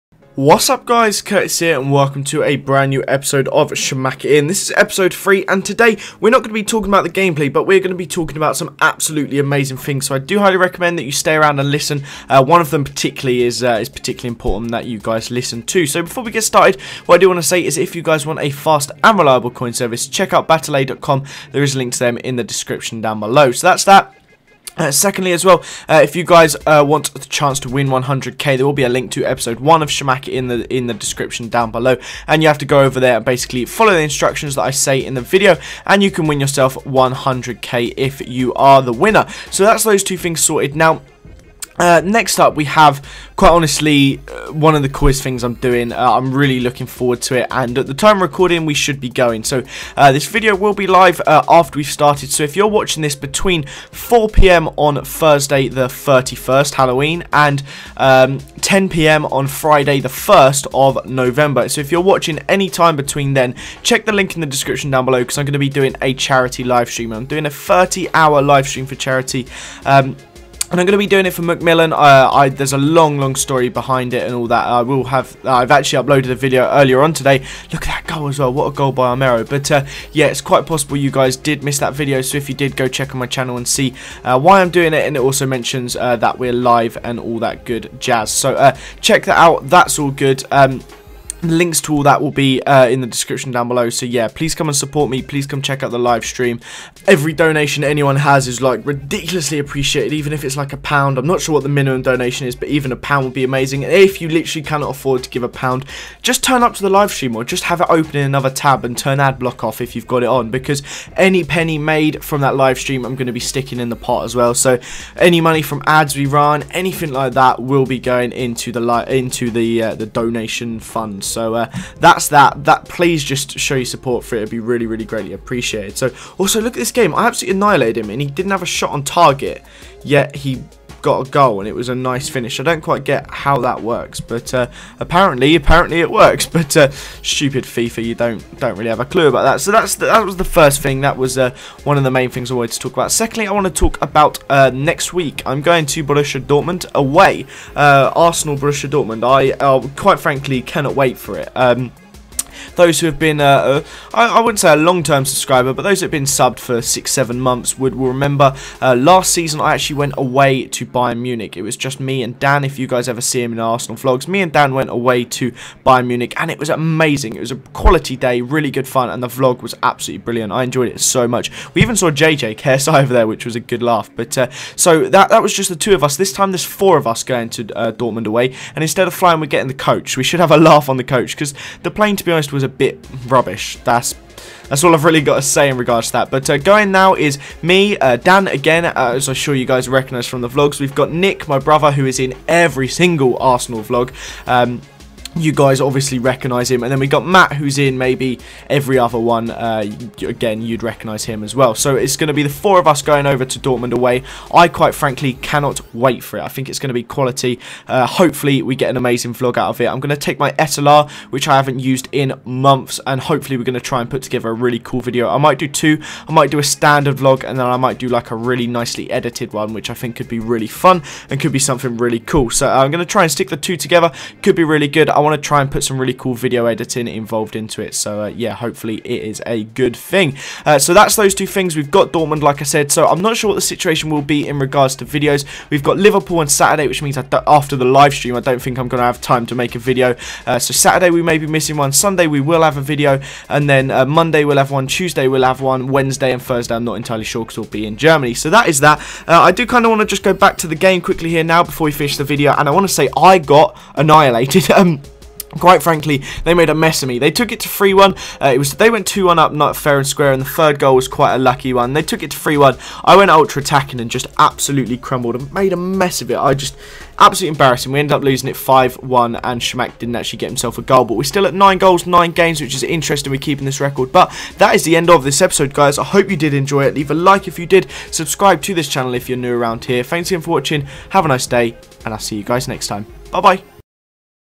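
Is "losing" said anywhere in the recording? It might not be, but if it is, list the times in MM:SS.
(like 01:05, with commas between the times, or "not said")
04:28.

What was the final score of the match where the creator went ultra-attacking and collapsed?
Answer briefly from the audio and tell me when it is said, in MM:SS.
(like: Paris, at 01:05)
5-1, at 04:28.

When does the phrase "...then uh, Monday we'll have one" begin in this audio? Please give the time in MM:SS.
04:03.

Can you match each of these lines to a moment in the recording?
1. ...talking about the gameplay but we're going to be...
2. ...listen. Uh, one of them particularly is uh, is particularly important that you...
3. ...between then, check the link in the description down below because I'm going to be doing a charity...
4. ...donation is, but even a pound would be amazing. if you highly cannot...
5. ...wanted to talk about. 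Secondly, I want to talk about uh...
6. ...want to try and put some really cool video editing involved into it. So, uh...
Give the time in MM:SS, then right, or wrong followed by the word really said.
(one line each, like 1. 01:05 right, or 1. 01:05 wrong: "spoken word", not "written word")
1. 00:06 right
2. 00:11 right
3. 01:02 right
4. 01:42 wrong: "literally", not "highly"
5. 02:22 right
6. 03:45 right.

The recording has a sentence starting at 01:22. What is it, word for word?
So if you did, go check on my channel and see uh, why I'm doing it.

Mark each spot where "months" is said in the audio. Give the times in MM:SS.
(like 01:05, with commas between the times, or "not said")
02:37, 03:32.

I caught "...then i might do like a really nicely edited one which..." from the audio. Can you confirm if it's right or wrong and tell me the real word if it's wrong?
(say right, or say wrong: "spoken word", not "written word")
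right.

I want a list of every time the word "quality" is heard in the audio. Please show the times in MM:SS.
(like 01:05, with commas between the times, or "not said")
02:47, 03:27.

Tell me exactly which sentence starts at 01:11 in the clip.
Uh, I, there's a long, long story behind it and all that.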